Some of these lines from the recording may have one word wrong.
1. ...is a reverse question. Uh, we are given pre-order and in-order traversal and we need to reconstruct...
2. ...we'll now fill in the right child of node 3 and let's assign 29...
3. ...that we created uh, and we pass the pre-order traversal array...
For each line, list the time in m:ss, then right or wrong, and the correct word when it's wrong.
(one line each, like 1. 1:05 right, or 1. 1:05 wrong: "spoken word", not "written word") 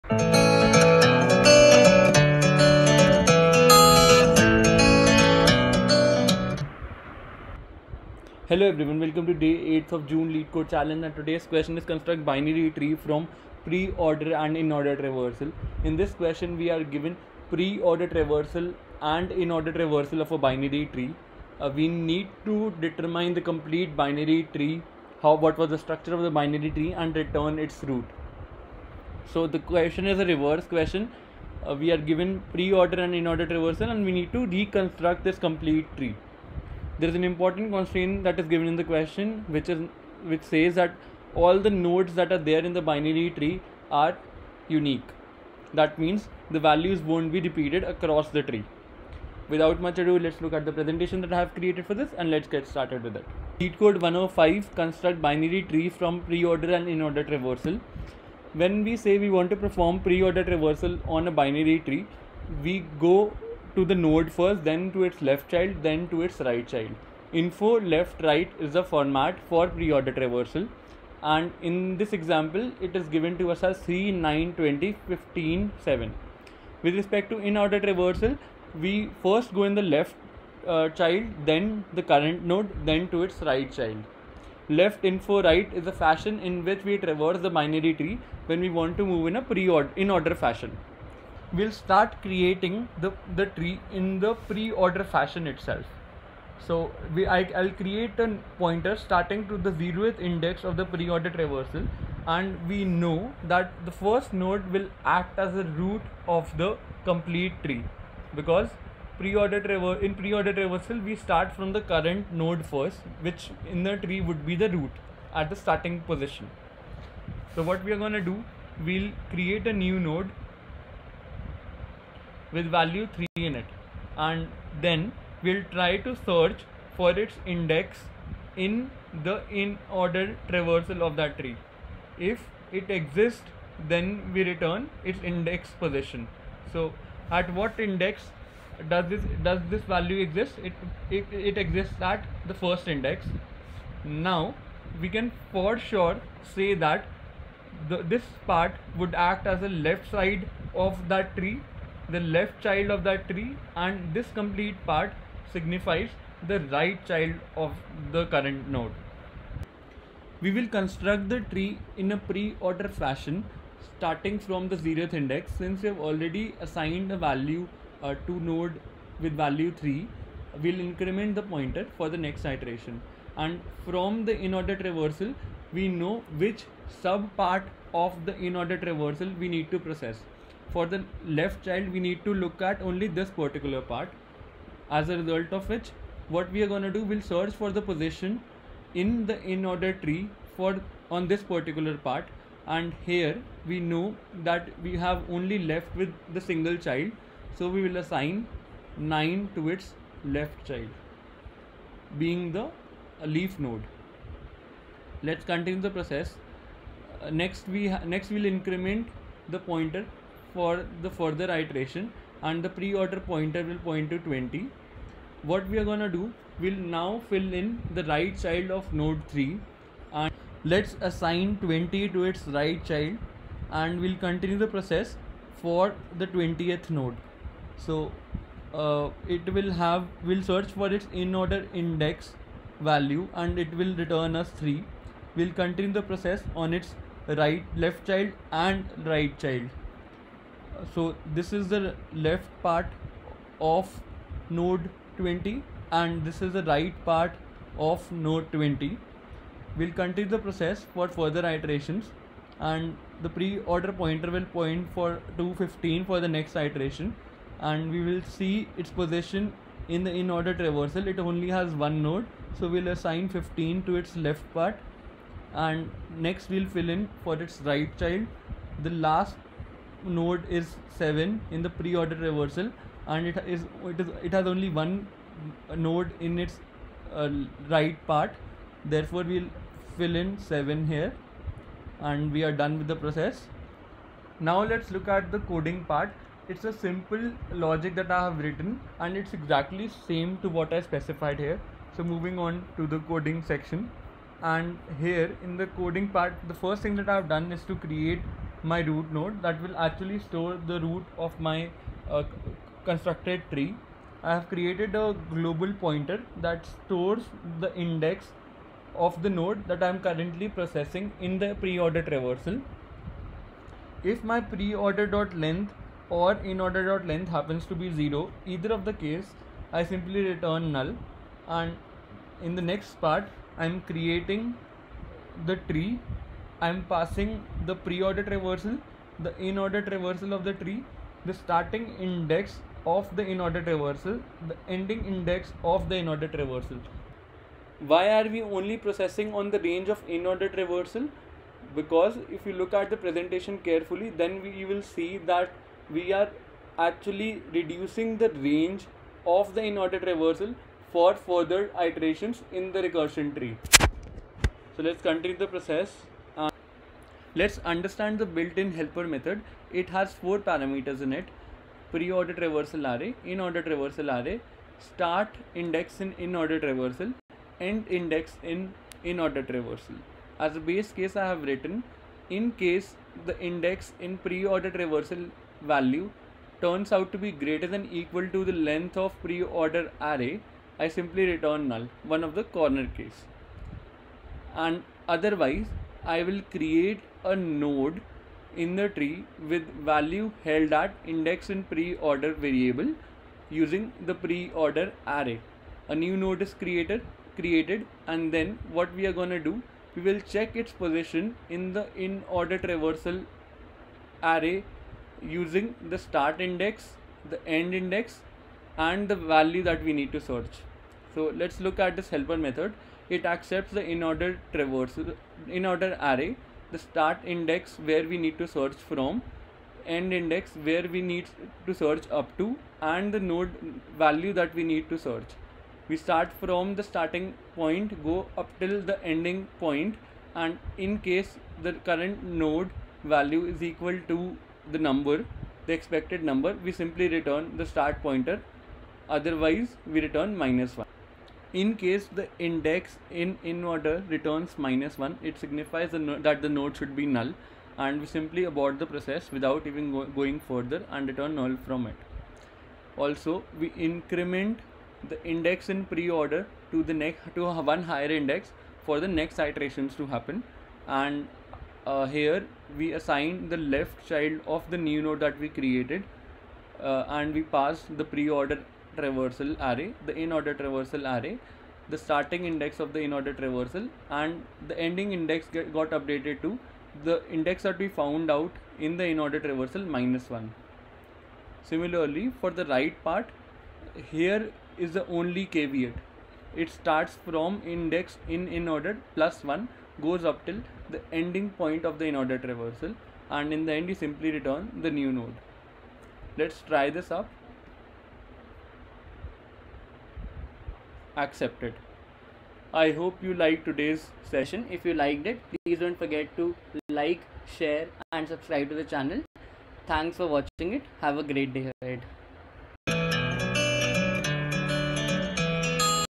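1. 0:30 right
2. 3:36 wrong: "20", not "29"
3. 7:45 right.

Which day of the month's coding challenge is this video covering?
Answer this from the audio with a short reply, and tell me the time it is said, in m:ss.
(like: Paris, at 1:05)
8th of June, at 0:09.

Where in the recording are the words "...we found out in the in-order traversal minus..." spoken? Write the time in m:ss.
7:57.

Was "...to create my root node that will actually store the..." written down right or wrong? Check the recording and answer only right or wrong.
right.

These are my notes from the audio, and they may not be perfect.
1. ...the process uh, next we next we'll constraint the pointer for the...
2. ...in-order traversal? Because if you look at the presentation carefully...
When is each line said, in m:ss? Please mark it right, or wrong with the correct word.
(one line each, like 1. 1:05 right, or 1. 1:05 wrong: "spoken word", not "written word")
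1. 3:25 wrong: "increment", not "constraint"
2. 5:40 right.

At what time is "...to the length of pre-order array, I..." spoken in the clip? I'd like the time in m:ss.
6:18.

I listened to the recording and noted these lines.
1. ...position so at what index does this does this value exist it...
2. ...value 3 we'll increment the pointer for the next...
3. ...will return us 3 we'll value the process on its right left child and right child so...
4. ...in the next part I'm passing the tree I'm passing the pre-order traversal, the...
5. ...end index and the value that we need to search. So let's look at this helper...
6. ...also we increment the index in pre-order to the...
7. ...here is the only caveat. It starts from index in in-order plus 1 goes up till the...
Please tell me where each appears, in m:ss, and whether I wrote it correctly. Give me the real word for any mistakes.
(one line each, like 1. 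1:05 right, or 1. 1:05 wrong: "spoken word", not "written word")
1. 2:15 right
2. 2:49 right
3. 3:53 wrong: "continue", not "value"
4. 5:22 wrong: "creating", not "passing"
5. 6:47 right
6. 7:32 right
7. 8:04 right.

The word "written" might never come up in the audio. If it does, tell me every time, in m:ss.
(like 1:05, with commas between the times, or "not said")
4:48, 6:11.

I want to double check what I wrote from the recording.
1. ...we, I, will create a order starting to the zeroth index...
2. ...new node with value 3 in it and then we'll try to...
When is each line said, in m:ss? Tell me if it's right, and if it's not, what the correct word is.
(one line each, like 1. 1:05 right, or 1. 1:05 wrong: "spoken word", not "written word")
1. 1:37 wrong: "pointer", not "order"
2. 1:59 right.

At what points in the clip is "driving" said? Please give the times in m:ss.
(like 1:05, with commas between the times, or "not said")
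not said.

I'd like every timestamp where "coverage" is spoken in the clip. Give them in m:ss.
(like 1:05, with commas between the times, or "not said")
not said.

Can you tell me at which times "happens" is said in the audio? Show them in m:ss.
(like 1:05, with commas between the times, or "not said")
5:17, 7:40.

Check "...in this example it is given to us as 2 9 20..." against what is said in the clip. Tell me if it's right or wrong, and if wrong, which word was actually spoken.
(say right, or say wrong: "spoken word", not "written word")
wrong: "3", not "2".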